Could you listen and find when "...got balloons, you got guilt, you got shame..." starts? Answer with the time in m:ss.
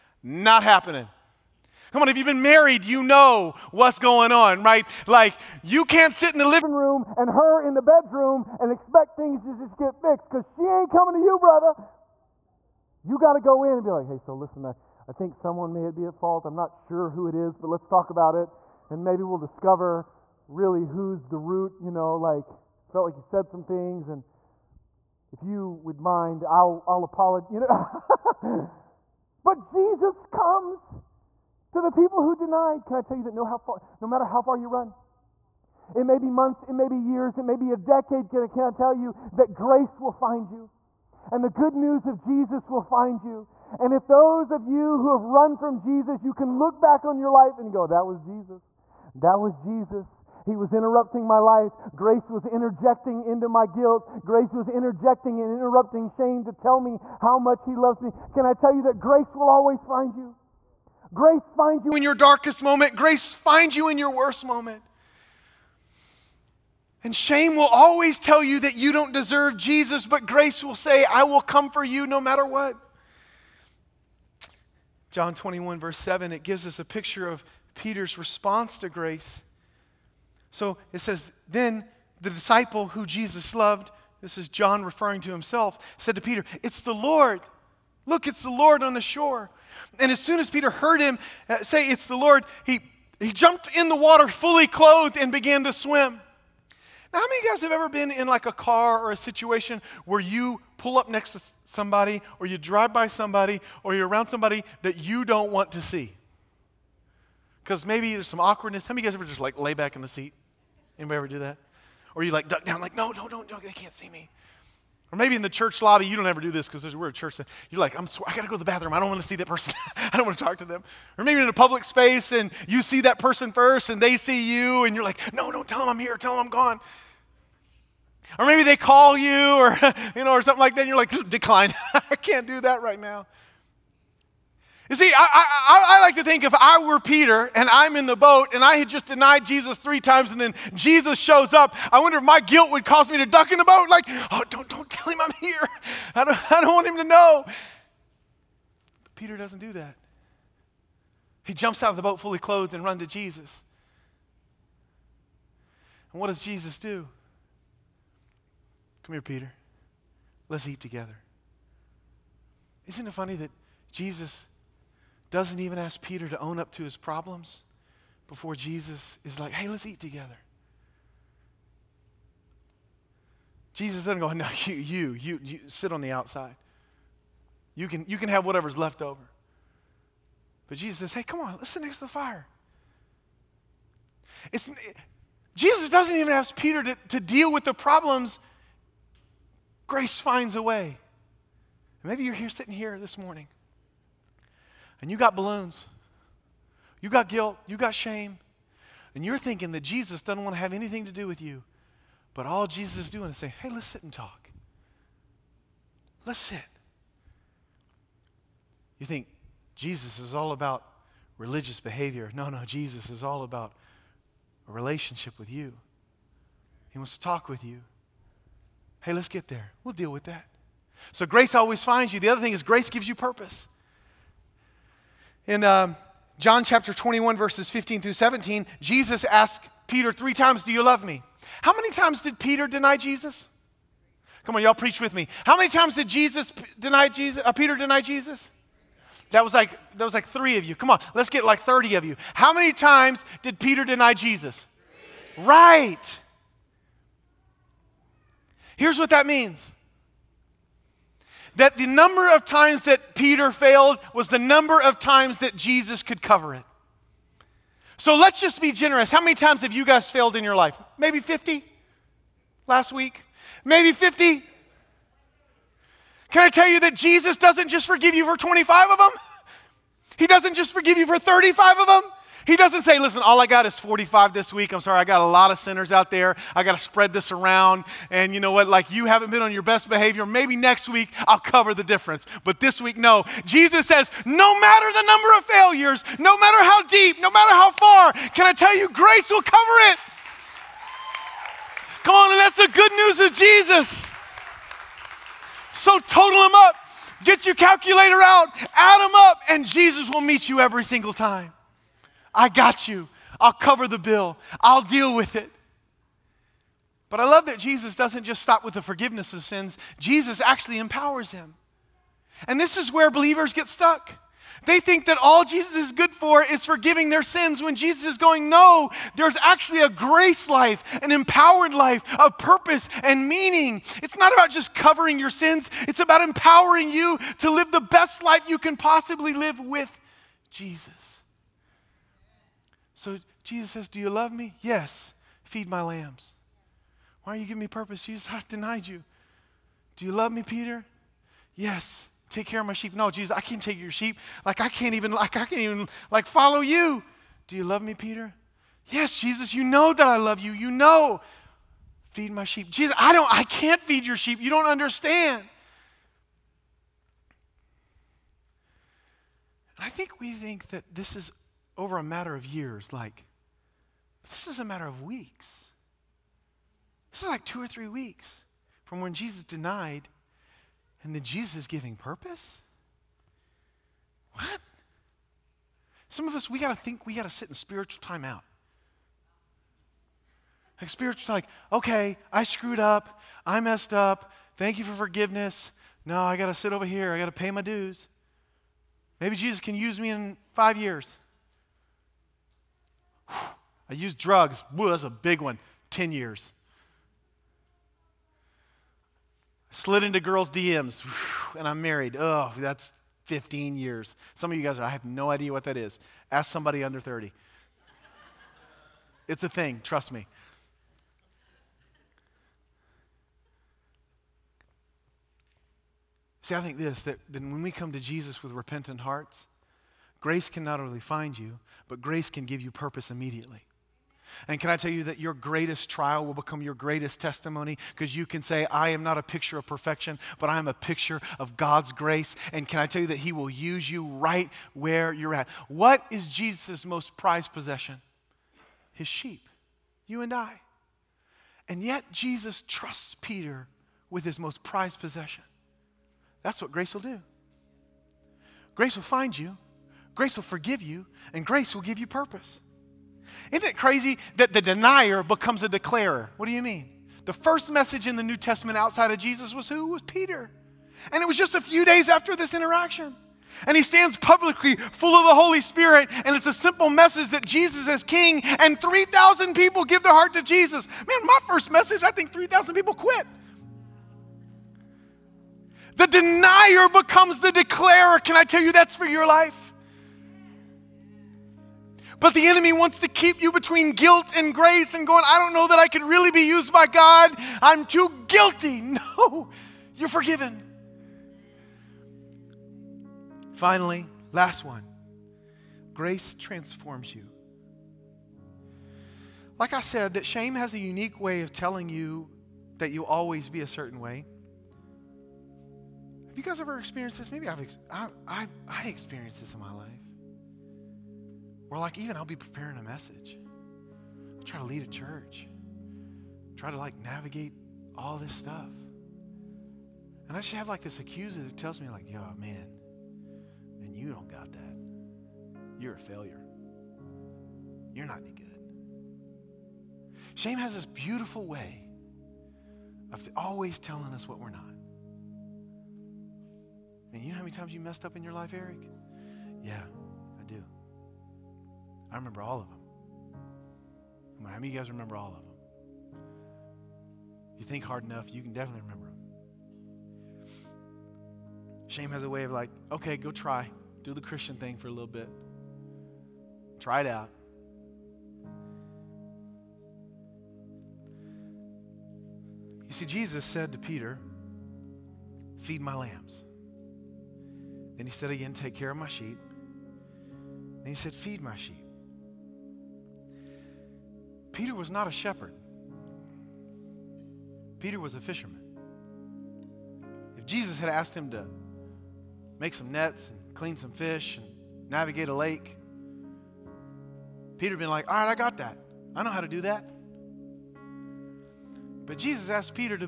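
3:15.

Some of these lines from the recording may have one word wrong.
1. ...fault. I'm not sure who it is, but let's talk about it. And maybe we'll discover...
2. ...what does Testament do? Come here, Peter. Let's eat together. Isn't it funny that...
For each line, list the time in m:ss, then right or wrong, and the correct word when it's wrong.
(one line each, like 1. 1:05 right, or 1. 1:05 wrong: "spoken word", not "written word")
1. 0:16 right
2. 2:36 wrong: "Jesus", not "Testament".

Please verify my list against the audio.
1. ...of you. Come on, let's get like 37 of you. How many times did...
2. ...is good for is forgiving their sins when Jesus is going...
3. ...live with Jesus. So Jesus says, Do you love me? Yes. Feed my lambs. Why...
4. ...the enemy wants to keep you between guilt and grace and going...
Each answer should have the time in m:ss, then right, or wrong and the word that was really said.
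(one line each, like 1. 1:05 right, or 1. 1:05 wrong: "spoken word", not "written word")
1. 4:00 wrong: "30", not "37"
2. 5:15 right
3. 5:29 right
4. 8:02 right.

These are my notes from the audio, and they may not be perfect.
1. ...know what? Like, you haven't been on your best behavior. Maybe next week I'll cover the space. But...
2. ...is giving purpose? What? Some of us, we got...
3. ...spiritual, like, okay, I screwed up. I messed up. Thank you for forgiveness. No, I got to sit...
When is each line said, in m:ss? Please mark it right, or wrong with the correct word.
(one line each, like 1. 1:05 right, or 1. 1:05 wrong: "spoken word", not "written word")
1. 4:38 wrong: "difference", not "space"
2. 6:11 right
3. 6:20 right.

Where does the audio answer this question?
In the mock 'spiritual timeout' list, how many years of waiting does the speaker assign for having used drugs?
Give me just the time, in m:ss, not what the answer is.
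6:35.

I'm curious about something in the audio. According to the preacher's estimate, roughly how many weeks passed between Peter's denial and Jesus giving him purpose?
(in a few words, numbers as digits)
2 or 3 weeks.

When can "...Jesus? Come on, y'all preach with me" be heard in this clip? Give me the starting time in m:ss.
3:52.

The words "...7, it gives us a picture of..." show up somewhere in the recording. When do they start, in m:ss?
1:15.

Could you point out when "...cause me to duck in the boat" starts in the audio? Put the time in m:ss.
2:22.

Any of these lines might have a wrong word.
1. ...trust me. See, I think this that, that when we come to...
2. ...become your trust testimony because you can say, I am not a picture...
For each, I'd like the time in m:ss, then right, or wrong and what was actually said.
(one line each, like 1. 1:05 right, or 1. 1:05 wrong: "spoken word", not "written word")
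1. 6:49 right
2. 7:06 wrong: "greatest", not "trust".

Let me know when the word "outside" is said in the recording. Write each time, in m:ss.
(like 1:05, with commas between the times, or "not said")
2:56, 7:38.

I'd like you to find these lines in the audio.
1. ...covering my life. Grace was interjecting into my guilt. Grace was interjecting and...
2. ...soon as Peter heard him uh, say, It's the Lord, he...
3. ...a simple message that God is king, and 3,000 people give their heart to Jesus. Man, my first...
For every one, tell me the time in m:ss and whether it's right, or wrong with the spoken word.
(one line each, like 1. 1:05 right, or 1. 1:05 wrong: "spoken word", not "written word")
1. 0:50 wrong: "interrupting", not "covering"
2. 1:30 right
3. 7:46 wrong: "Jesus", not "God".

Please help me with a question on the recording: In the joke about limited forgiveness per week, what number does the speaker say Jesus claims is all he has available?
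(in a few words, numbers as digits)
45.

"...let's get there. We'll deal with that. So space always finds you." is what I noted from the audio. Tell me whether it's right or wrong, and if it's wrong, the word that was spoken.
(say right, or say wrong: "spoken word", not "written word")
wrong: "grace", not "space".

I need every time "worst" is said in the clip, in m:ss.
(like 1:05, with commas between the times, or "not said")
1:04.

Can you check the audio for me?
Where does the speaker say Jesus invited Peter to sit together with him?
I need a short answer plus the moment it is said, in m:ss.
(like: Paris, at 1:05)
next to the fire, at 3:01.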